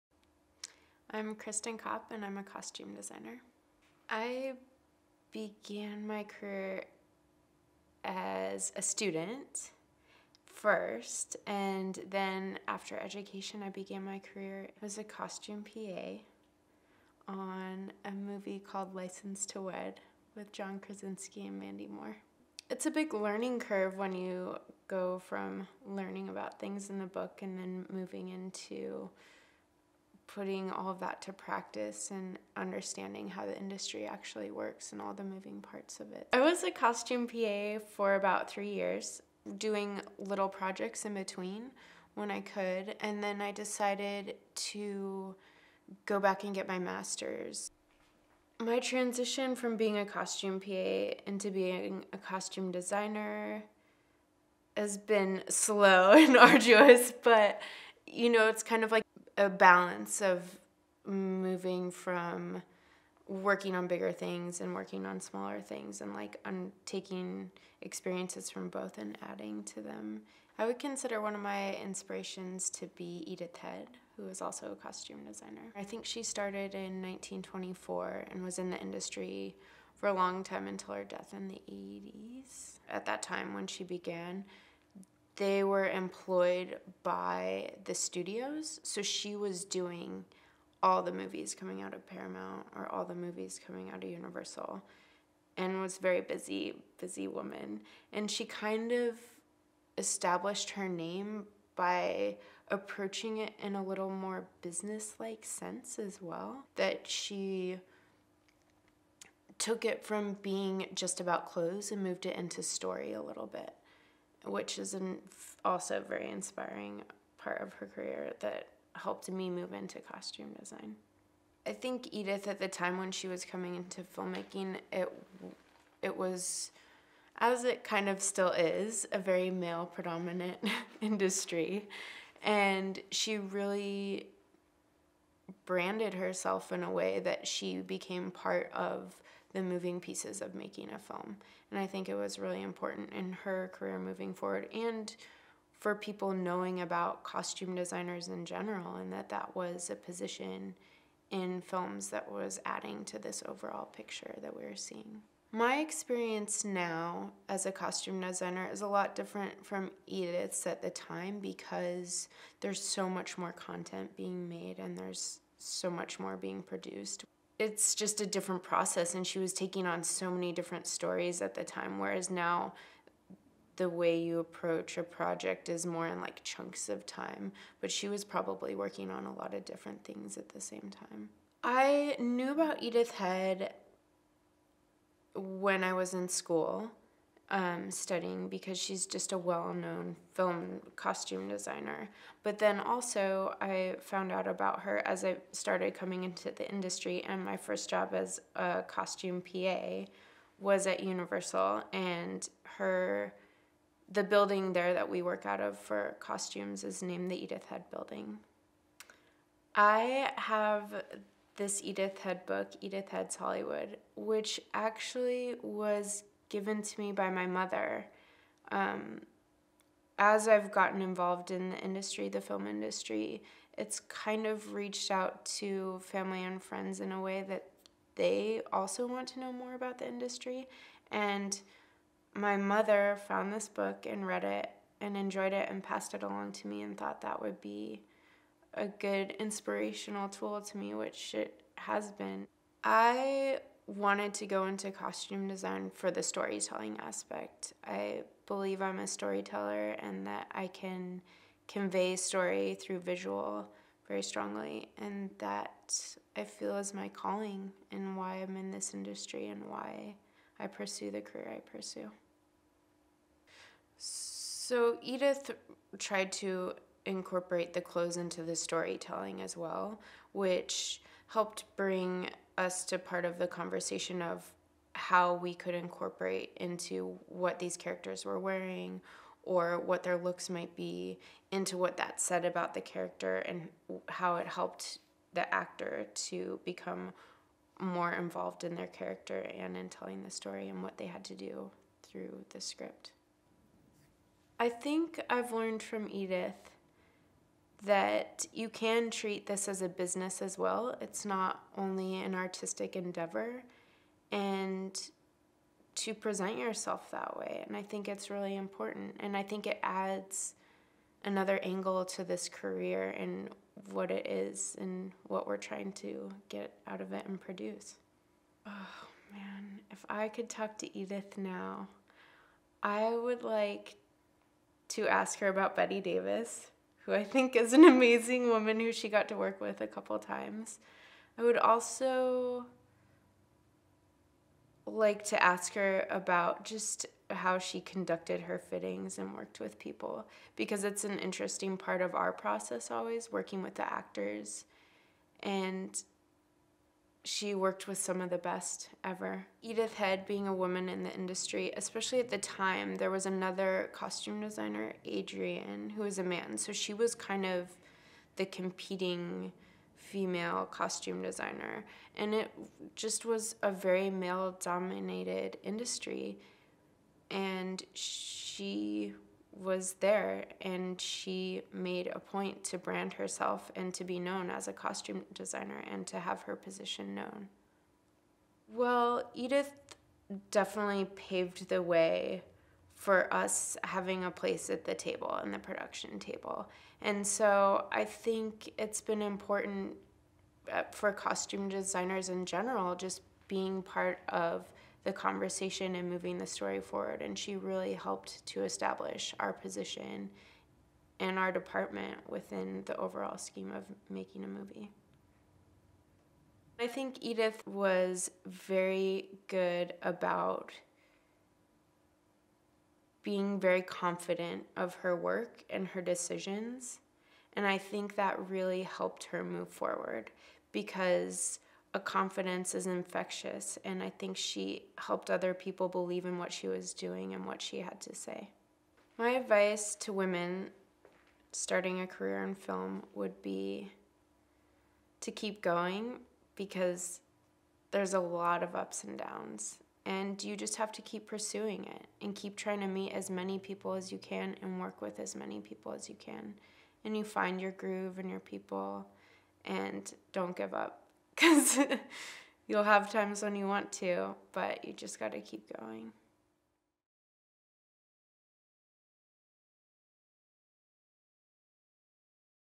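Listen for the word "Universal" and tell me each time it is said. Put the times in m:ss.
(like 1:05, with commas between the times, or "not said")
1:34, 3:21.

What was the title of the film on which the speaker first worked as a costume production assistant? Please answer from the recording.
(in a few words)
License to Wed.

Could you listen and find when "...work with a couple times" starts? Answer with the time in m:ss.
5:29.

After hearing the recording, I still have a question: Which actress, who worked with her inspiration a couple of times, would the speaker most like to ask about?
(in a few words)
Bette Davis.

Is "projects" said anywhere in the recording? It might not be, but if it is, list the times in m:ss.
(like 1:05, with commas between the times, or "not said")
0:40, 2:55.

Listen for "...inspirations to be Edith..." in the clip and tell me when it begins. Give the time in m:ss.
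1:11.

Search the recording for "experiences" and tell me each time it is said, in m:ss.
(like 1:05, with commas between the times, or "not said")
1:07, 2:35.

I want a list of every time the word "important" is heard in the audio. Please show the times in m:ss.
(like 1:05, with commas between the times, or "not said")
2:22, 5:08, 6:29.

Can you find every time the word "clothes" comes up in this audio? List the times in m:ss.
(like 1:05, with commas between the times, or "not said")
1:51, 4:27.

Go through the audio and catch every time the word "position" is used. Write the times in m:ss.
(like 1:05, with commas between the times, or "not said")
2:29, 6:16, 6:39.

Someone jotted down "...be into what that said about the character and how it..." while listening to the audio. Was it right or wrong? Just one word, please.
right.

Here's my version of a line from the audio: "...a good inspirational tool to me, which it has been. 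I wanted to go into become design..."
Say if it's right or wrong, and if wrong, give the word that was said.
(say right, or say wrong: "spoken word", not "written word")
wrong: "costume", not "become".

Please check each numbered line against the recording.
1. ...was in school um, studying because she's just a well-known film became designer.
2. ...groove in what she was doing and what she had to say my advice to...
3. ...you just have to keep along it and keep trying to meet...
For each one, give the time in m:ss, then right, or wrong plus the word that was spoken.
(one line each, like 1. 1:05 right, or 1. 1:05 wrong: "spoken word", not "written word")
1. 3:05 wrong: "costume", not "became"
2. 7:05 wrong: "believe", not "groove"
3. 7:20 wrong: "pursuing", not "along".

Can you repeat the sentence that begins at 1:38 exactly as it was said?
And she kind of established her name by approaching it in a little more business like sense as well.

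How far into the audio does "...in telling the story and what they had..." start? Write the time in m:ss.
4:49.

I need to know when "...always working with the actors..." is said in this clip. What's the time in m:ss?
5:42.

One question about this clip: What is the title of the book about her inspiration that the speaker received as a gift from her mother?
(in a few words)
Edith Head's Hollywood.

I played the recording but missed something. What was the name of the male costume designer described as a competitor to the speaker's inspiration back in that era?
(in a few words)
Adrian.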